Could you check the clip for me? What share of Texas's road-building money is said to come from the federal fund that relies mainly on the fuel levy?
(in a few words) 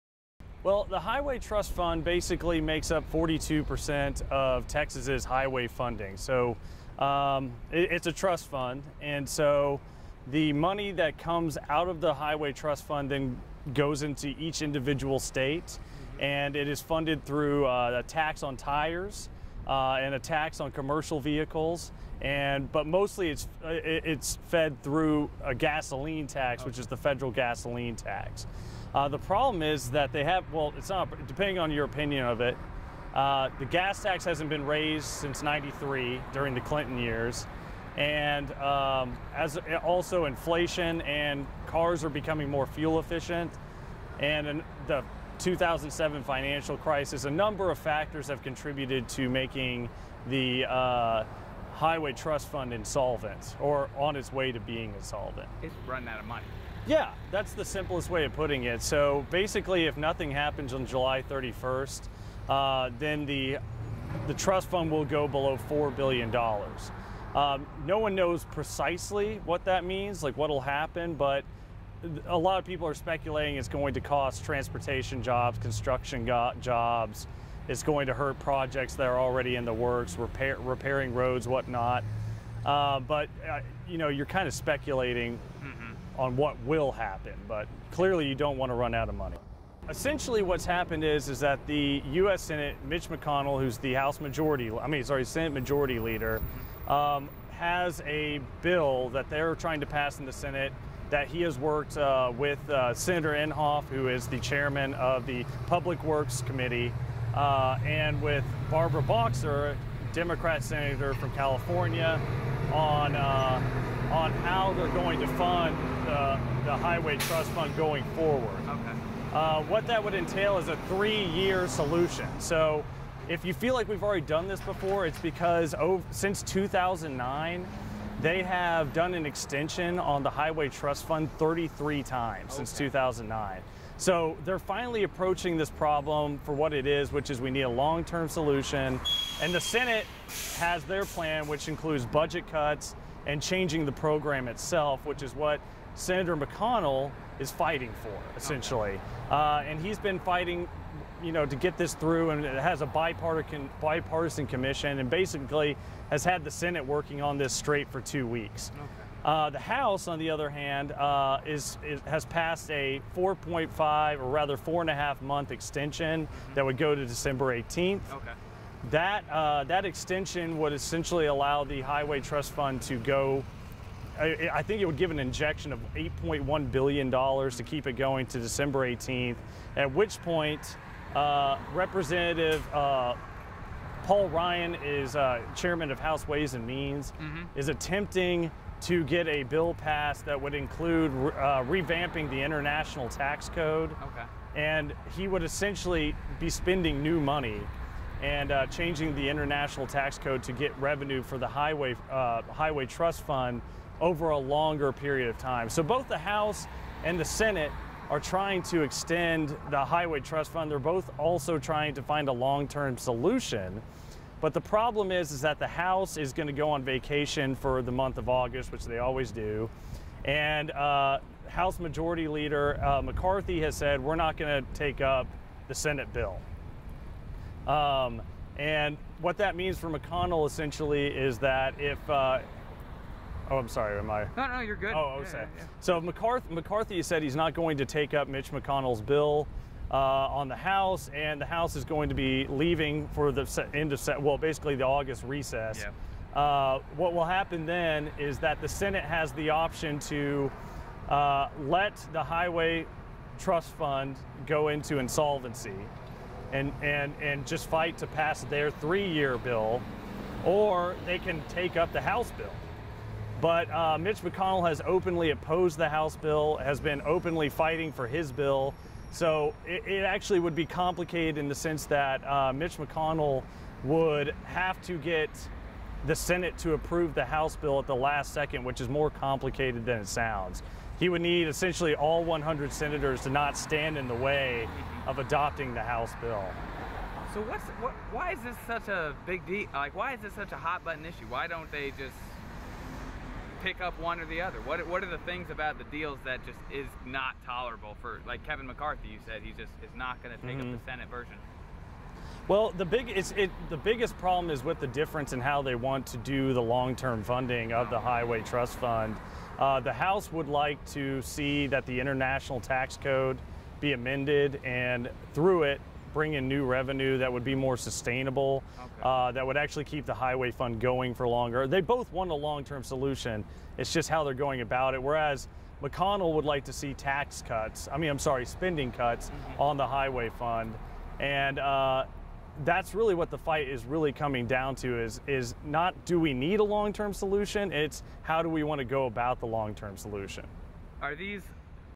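42%.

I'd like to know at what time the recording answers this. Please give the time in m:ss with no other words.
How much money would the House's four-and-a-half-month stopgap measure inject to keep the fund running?
2:55.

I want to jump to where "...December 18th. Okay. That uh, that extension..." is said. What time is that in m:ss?
2:47.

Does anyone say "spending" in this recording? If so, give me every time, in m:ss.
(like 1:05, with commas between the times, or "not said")
3:16, 5:28.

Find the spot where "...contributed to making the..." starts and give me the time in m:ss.
0:48.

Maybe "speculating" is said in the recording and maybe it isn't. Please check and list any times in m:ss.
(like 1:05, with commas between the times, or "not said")
1:12, 1:24.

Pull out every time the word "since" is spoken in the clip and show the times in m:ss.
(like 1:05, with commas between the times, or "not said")
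0:35, 2:06, 2:12.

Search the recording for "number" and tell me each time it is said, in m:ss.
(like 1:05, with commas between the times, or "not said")
0:47.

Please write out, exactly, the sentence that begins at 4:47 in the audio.
So what's what, why is this such a big deal?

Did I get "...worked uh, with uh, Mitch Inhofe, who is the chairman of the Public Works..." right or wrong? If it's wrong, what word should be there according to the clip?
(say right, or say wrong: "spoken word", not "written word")
wrong: "Senator", not "Mitch".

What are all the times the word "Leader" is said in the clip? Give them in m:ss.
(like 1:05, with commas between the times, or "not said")
1:35, 3:42.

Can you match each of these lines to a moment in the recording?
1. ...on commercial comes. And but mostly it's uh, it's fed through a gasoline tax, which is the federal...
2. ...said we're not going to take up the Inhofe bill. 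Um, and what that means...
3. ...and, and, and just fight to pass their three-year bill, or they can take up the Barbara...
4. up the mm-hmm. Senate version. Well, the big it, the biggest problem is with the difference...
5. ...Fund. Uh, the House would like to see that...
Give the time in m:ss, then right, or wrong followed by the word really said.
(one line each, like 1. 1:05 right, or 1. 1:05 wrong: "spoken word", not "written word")
1. 0:20 wrong: "vehicles", not "comes"
2. 3:43 wrong: "Senate", not "Inhofe"
3. 4:16 wrong: "House", not "Barbara"
4. 5:00 right
5. 5:08 right.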